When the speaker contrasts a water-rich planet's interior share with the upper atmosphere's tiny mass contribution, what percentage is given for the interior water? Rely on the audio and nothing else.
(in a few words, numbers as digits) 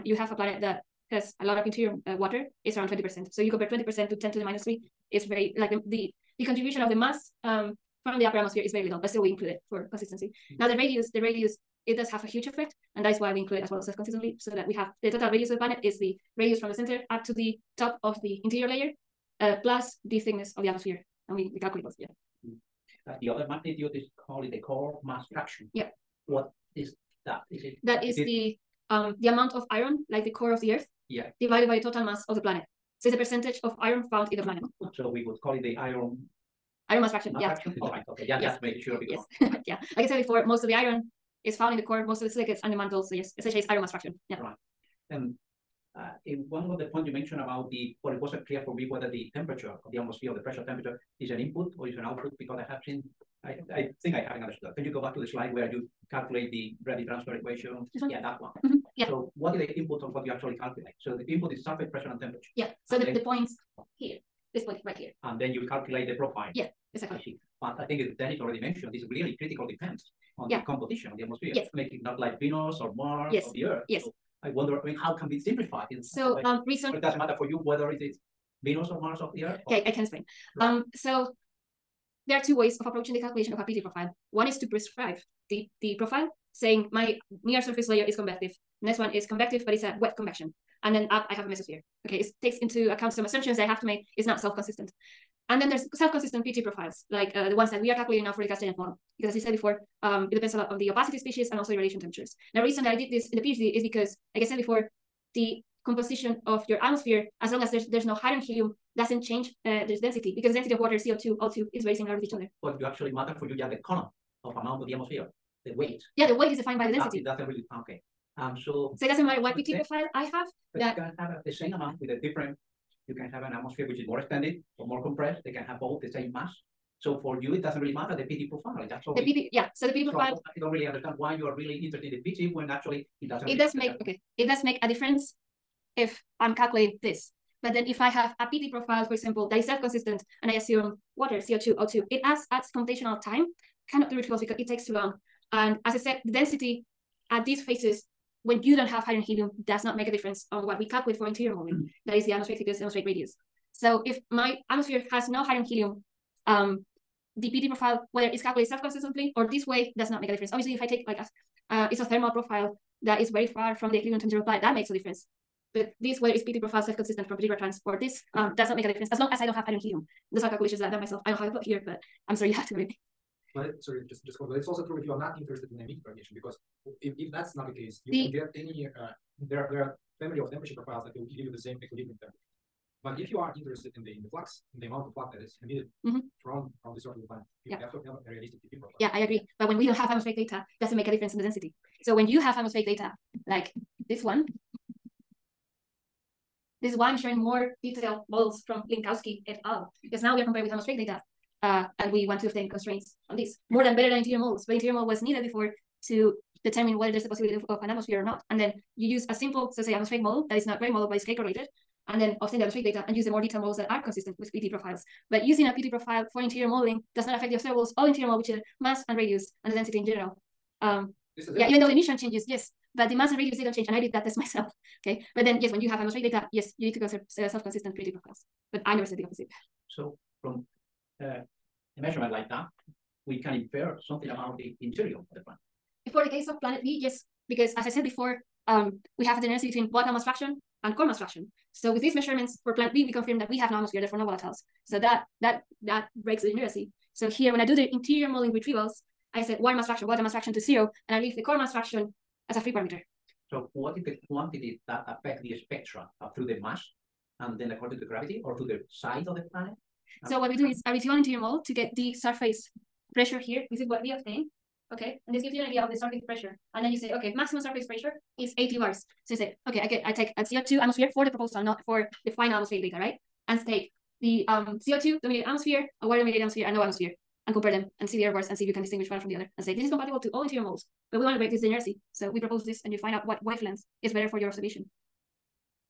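20%.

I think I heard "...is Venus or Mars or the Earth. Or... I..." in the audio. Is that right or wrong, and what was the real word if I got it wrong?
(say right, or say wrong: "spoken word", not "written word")
right.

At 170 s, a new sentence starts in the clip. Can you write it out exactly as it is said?
The calculations that I done myself.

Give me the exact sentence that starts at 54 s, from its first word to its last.
Uh, can you go back to the slide where you calculate the gravity transfer equation?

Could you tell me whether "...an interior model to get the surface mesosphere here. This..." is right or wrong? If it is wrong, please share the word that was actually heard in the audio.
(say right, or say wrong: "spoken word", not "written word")
wrong: "pressure", not "mesosphere".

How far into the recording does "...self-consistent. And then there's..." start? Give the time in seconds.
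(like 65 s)
94 s.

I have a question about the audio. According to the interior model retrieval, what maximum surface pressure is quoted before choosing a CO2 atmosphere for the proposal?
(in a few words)
80 bars.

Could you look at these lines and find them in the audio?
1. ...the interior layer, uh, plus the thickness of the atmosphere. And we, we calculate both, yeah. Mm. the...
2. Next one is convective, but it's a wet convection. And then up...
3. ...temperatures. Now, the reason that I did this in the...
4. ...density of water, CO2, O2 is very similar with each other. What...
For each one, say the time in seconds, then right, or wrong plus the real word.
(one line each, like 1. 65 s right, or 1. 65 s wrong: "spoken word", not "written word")
1. 18 s right
2. 88 s right
3. 102 s right
4. 110 s right.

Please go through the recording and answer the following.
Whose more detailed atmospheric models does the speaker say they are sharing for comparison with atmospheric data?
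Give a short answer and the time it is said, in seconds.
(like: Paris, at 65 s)
Lincowski et al., at 198 s.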